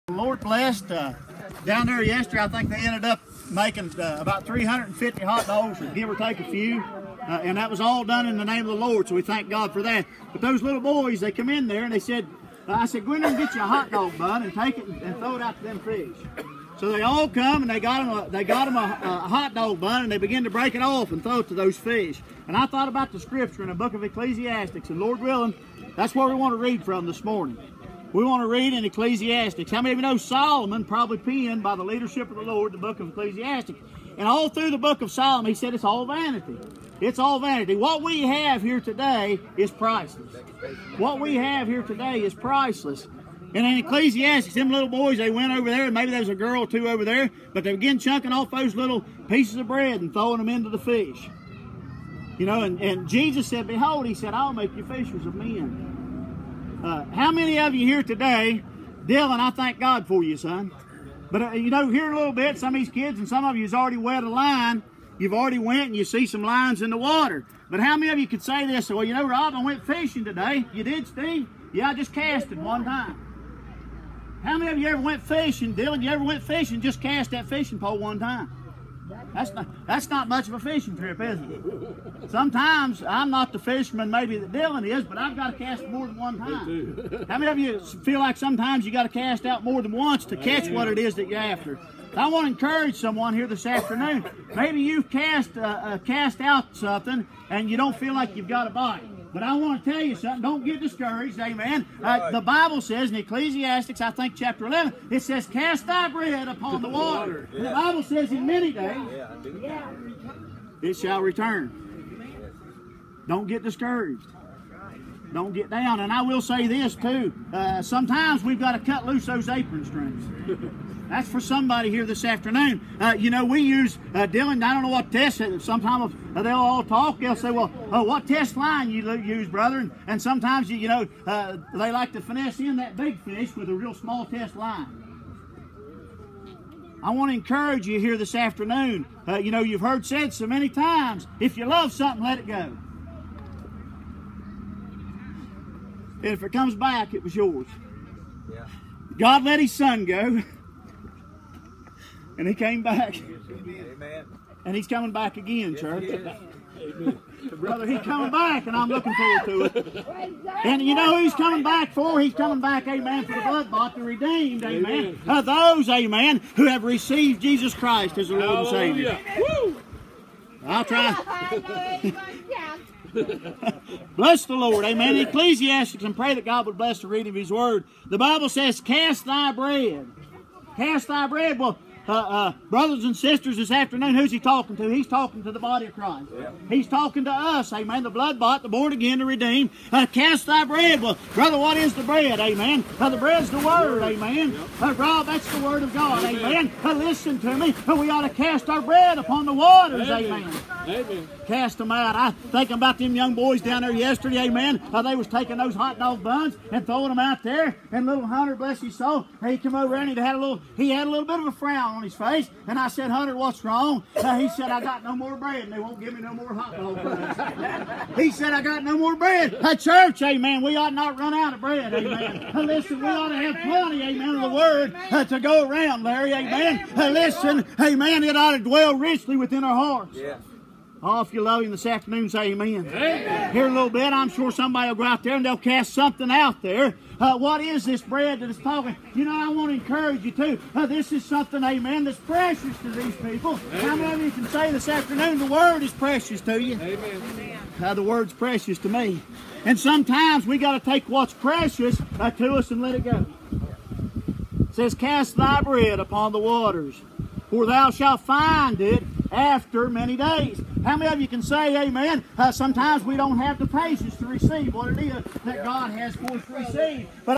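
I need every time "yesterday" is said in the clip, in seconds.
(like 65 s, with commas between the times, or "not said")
2 s, 203 s.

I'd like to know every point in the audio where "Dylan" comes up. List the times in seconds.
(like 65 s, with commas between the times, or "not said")
59 s, 75 s, 84 s, 124 s.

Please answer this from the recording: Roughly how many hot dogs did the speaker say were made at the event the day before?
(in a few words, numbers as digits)
350.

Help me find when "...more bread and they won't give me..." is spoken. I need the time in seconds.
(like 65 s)
215 s.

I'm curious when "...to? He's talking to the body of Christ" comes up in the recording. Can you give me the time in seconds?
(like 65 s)
184 s.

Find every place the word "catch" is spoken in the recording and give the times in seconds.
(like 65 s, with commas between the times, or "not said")
90 s.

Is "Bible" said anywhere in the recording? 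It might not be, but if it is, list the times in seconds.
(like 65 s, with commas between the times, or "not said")
102 s, 107 s, 178 s.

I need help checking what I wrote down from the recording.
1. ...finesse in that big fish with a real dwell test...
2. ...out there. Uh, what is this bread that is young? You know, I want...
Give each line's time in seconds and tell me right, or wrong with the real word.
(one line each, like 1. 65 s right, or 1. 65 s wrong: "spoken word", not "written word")
1. 132 s wrong: "small", not "dwell"
2. 236 s wrong: "talking", not "young".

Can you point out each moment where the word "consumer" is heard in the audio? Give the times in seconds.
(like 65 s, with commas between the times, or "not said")
not said.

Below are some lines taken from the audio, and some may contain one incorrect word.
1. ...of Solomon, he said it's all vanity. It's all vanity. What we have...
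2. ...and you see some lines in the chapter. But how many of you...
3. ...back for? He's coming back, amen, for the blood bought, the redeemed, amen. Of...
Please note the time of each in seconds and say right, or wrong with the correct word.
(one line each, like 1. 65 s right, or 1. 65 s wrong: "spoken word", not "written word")
1. 35 s right
2. 65 s wrong: "water", not "chapter"
3. 161 s right.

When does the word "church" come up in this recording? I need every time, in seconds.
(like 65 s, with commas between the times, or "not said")
155 s, 219 s.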